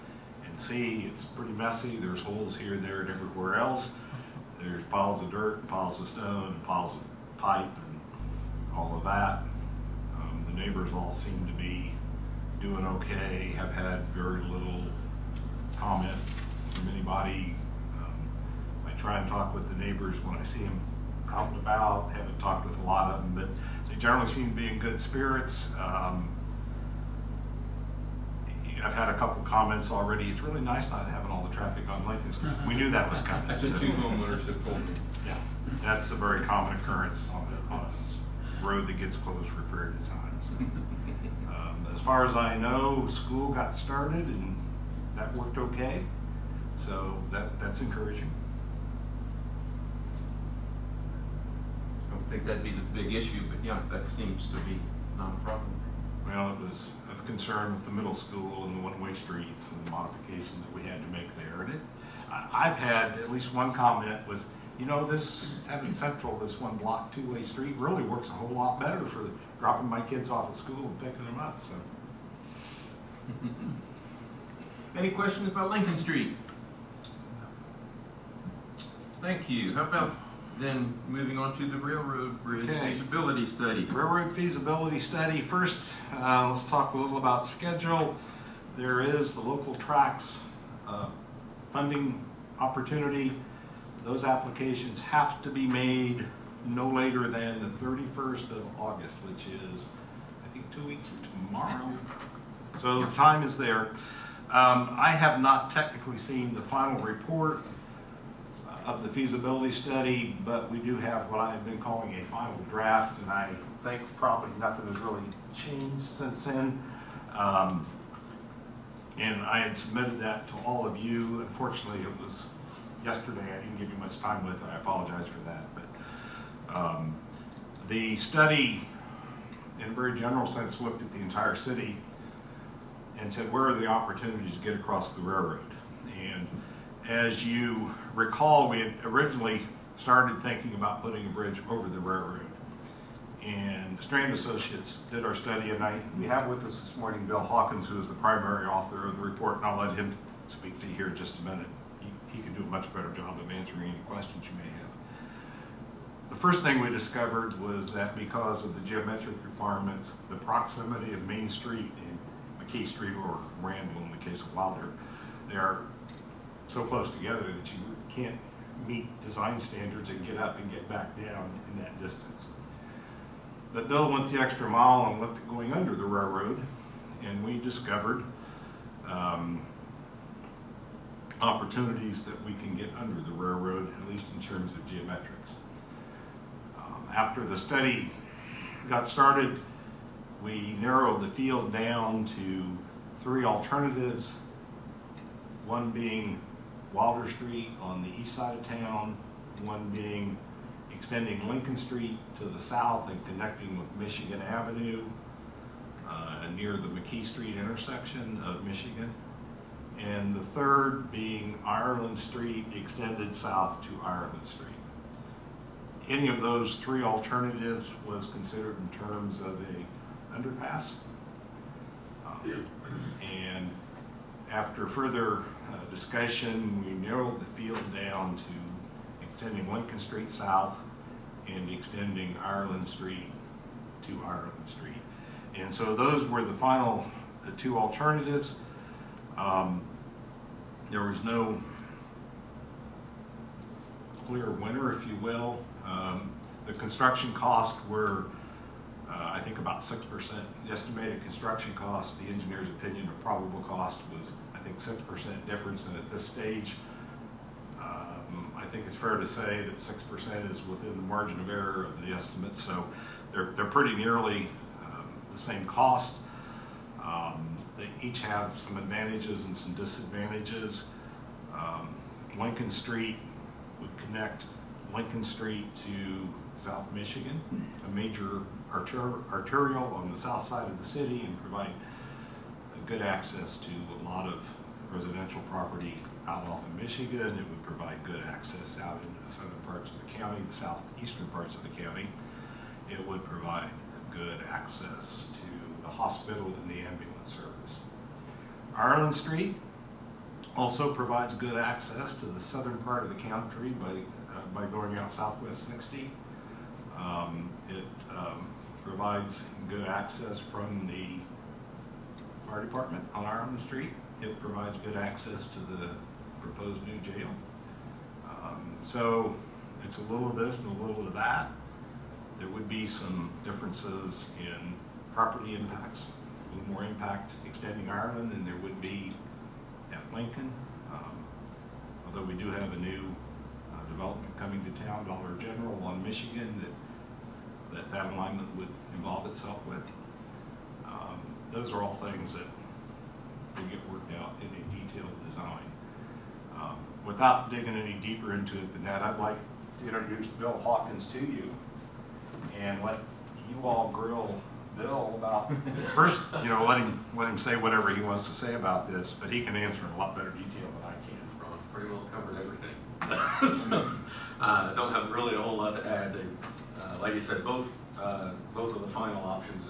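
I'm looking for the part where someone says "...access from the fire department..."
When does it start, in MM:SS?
05:09.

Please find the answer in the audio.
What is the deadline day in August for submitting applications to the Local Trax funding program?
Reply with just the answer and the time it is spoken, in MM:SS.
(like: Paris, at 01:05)
31st, at 01:37.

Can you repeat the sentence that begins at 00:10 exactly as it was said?
Um, the neighbors all seem to be doing okay.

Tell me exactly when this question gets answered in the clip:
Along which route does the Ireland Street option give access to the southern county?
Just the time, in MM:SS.
05:05.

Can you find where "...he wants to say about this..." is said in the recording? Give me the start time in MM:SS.
05:57.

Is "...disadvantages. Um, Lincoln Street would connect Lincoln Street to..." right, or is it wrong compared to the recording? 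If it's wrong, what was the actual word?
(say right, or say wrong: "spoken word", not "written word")
right.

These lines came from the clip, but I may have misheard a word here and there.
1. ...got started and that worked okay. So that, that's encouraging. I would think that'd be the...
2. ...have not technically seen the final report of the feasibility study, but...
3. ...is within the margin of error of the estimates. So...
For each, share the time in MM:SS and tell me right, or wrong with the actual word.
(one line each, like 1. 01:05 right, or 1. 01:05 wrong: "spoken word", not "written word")
1. 00:43 right
2. 01:45 right
3. 04:20 right.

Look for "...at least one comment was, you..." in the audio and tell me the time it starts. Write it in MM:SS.
01:03.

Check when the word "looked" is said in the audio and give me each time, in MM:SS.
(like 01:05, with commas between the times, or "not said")
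02:10, 02:55.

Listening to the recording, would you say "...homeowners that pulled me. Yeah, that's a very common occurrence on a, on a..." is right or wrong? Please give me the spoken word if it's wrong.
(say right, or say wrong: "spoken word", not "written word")
right.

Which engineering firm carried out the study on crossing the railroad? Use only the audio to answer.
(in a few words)
Strand Associates.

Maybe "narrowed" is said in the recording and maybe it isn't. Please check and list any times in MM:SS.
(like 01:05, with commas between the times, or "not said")
03:10, 03:47.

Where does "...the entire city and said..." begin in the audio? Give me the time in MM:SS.
02:11.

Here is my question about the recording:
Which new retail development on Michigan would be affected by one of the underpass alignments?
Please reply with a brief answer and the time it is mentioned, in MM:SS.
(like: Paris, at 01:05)
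Dollar General, at 05:35.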